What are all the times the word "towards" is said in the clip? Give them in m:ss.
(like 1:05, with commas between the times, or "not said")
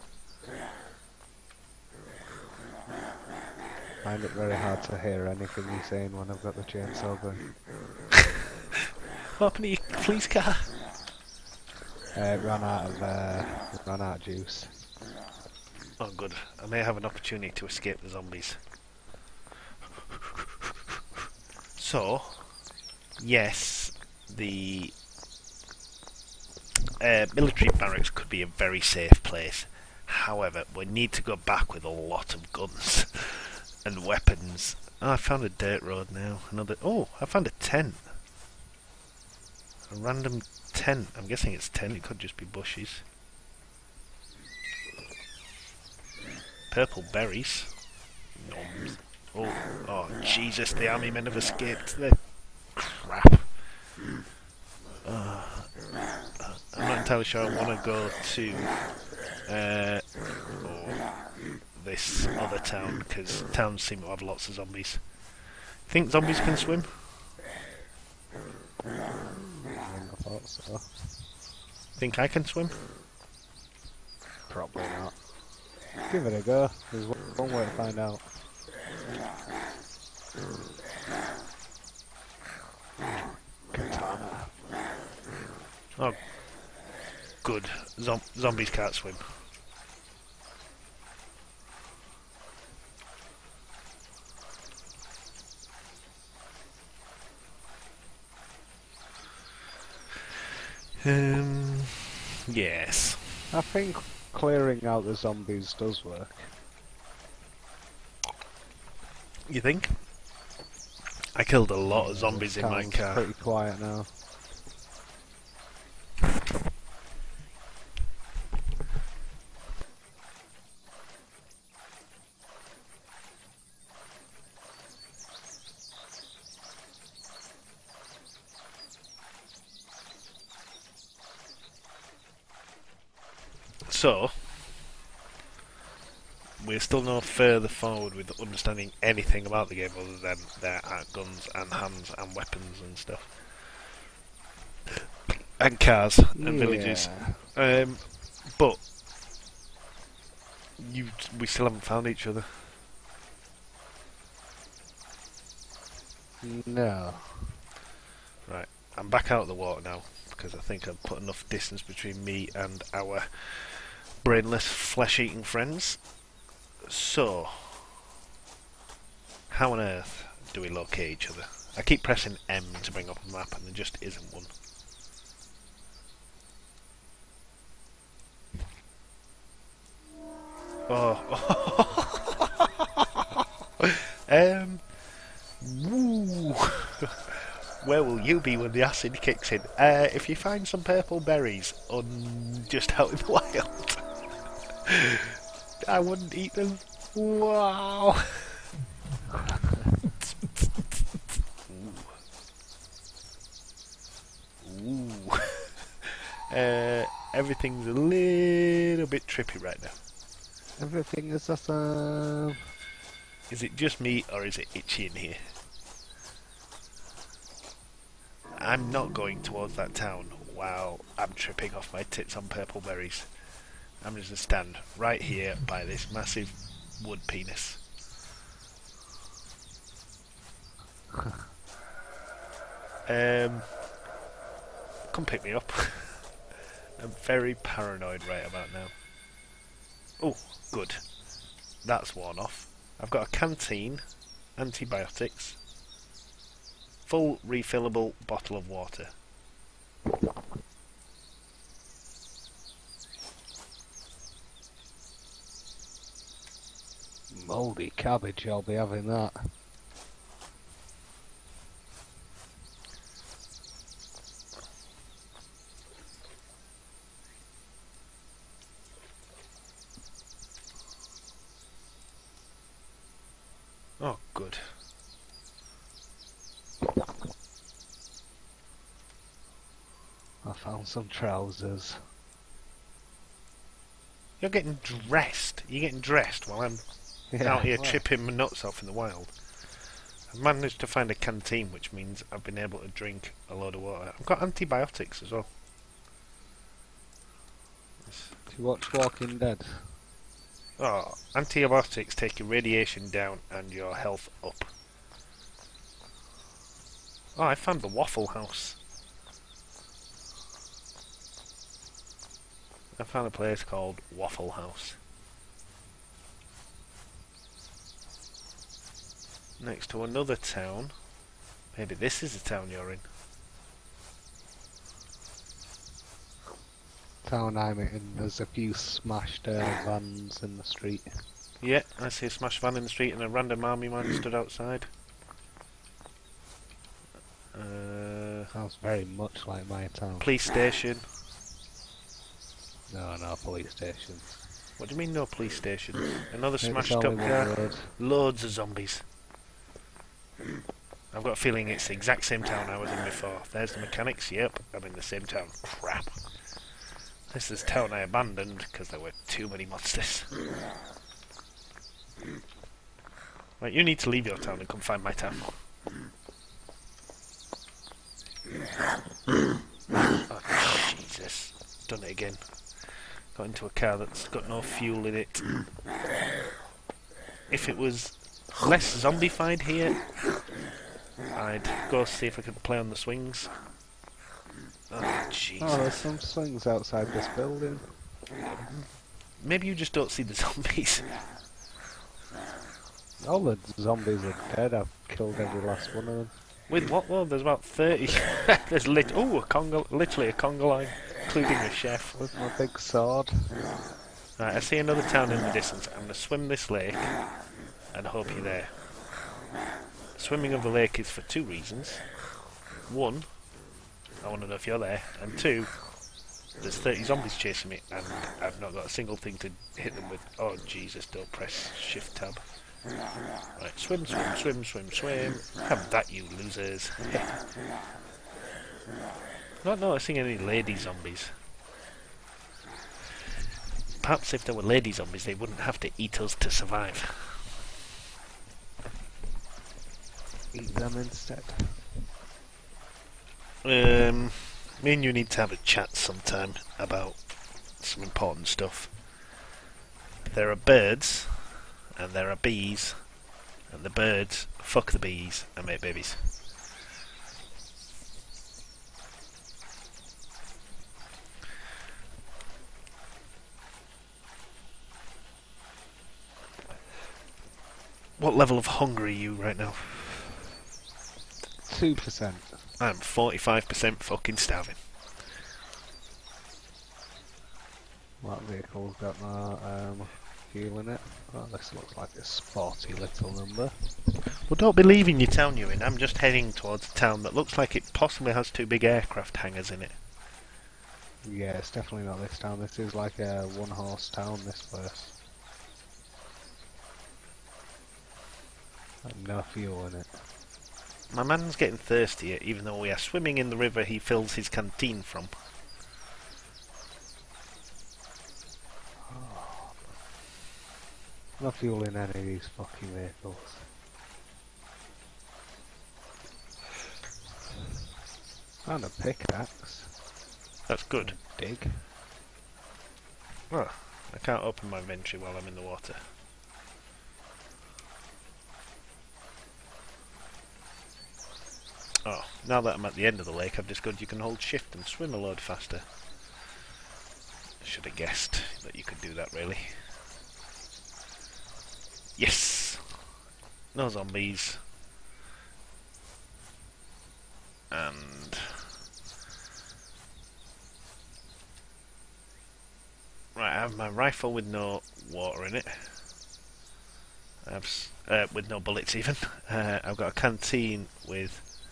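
3:39, 8:06.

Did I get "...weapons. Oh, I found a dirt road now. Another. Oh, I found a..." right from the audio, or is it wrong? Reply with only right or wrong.
right.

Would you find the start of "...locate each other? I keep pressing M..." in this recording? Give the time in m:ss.
2:50.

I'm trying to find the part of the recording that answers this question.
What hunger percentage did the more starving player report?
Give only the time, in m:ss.
7:52.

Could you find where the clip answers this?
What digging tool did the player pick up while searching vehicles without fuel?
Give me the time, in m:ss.
8:38.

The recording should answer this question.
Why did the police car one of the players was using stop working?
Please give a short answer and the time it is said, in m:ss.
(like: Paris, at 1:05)
Ran out of juice, at 0:13.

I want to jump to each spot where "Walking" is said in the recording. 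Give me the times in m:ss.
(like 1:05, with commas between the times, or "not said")
4:58.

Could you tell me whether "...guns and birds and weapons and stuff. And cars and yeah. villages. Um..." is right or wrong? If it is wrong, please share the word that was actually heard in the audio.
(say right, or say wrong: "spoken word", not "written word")
wrong: "hands", not "birds".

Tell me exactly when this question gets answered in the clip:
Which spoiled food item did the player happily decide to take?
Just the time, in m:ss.
4:17.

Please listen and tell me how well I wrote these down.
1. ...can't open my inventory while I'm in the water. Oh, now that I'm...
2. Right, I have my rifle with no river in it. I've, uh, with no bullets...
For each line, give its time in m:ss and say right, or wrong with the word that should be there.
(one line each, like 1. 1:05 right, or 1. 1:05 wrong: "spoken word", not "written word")
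1. 8:44 right
2. 9:13 wrong: "water", not "river".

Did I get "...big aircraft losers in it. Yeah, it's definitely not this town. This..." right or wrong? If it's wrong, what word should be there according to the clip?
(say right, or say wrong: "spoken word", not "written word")
wrong: "hangars", not "losers".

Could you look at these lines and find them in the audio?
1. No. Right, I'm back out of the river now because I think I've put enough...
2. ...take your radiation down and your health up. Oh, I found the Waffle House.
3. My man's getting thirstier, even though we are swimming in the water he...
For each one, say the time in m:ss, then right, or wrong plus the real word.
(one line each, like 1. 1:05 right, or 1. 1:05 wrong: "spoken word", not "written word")
1. 2:36 wrong: "water", not "river"
2. 5:02 right
3. 8:21 wrong: "river", not "water".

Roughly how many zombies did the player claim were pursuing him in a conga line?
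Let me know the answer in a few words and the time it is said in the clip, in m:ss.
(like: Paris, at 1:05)
30, at 6:37.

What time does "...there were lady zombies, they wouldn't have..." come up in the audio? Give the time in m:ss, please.
7:14.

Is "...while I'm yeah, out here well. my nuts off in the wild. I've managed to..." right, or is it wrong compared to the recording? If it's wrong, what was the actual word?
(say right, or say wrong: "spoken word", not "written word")
right.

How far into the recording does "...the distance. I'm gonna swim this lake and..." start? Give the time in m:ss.
6:45.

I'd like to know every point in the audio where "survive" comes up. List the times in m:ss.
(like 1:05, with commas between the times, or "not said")
7:16.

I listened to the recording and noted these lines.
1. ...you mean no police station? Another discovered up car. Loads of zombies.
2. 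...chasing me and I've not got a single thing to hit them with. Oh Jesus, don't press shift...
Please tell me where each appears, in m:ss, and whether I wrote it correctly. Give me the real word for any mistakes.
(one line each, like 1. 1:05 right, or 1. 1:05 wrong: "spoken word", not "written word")
1. 5:44 wrong: "smashed", not "discovered"
2. 6:57 right.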